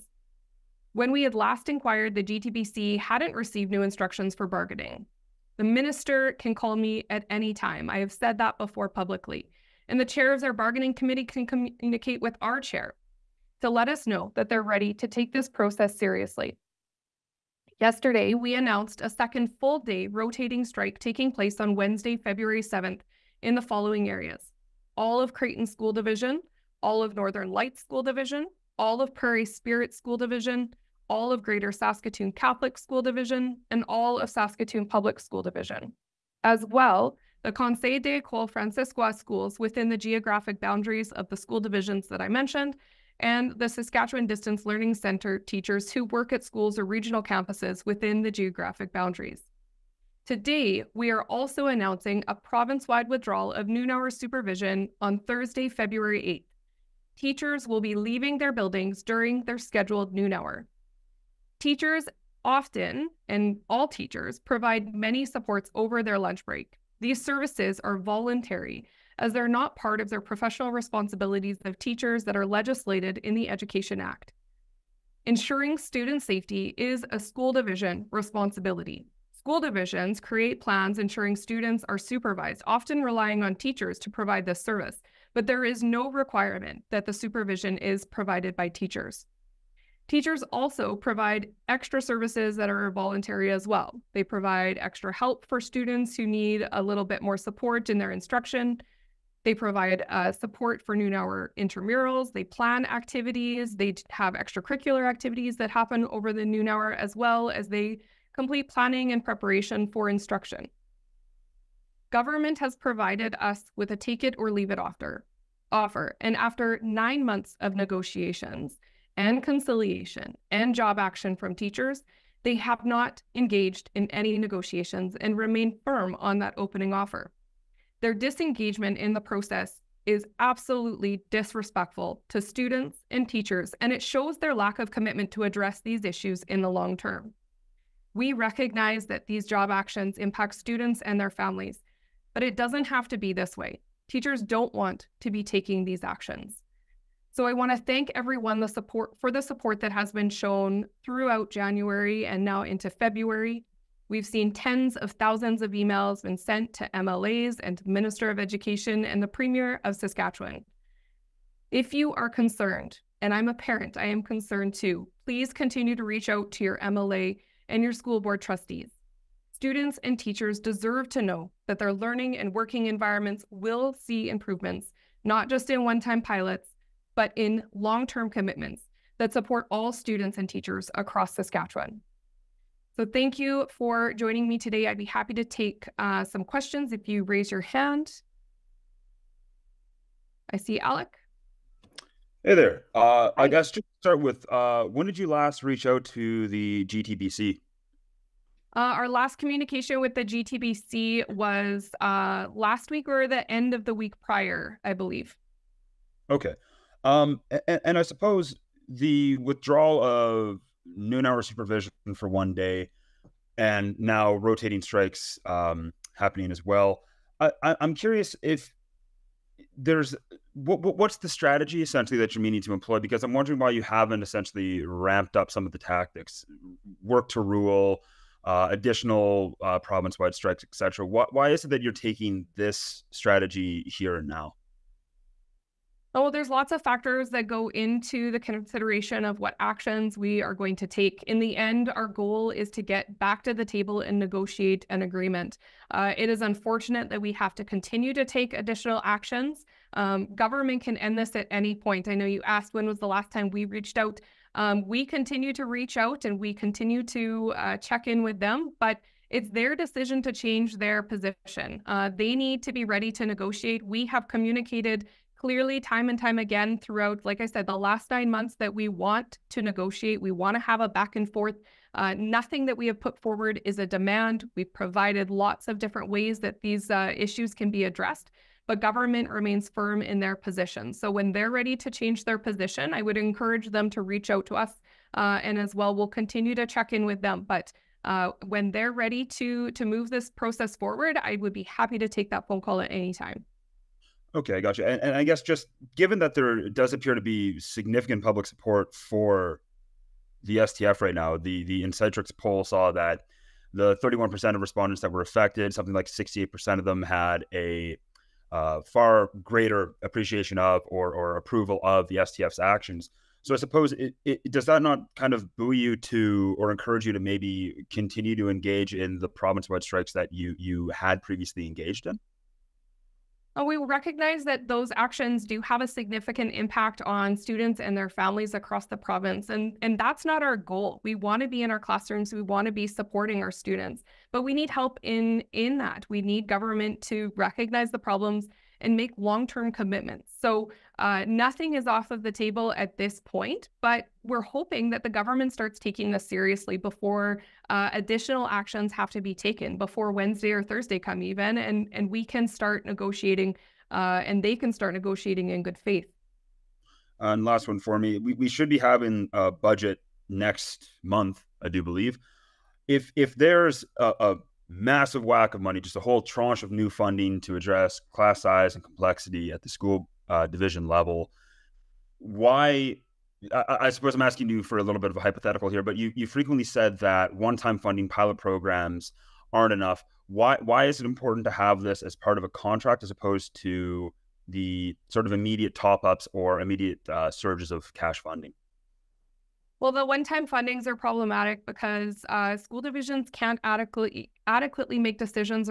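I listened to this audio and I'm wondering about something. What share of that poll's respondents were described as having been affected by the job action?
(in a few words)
31%.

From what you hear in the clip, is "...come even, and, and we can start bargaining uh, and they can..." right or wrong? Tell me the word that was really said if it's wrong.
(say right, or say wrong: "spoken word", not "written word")
wrong: "negotiating", not "bargaining".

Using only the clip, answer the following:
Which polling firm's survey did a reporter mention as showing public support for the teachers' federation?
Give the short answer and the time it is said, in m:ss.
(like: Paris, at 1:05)
Insightrix, at 5:01.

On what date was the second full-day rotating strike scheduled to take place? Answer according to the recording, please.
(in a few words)
February 7th.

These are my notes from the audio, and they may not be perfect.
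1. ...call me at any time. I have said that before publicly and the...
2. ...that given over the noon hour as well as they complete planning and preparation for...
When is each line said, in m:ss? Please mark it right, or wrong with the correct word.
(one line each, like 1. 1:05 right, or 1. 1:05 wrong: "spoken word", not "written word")
1. 0:06 right
2. 1:45 wrong: "happen", not "given".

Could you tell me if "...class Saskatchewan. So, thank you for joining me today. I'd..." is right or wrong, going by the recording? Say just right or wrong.
wrong.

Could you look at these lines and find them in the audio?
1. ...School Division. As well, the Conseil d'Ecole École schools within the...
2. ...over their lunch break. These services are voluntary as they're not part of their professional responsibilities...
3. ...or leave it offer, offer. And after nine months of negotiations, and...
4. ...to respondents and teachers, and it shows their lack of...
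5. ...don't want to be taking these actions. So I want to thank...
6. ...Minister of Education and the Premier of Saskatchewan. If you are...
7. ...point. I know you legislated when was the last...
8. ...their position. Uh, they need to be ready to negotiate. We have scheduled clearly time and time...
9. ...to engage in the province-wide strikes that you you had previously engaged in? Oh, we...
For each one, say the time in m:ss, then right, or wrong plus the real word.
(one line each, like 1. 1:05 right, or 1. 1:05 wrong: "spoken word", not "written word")
1. 0:35 right
2. 1:05 right
3. 1:54 right
4. 2:12 wrong: "students", not "respondents"
5. 2:24 right
6. 2:37 right
7. 4:11 wrong: "asked", not "legislated"
8. 4:20 wrong: "communicated", not "scheduled"
9. 5:18 right.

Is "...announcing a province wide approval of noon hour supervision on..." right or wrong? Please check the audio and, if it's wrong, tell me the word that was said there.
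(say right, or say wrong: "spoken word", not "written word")
wrong: "withdrawal", not "approval".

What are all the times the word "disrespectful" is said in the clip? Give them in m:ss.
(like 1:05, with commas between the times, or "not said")
2:11.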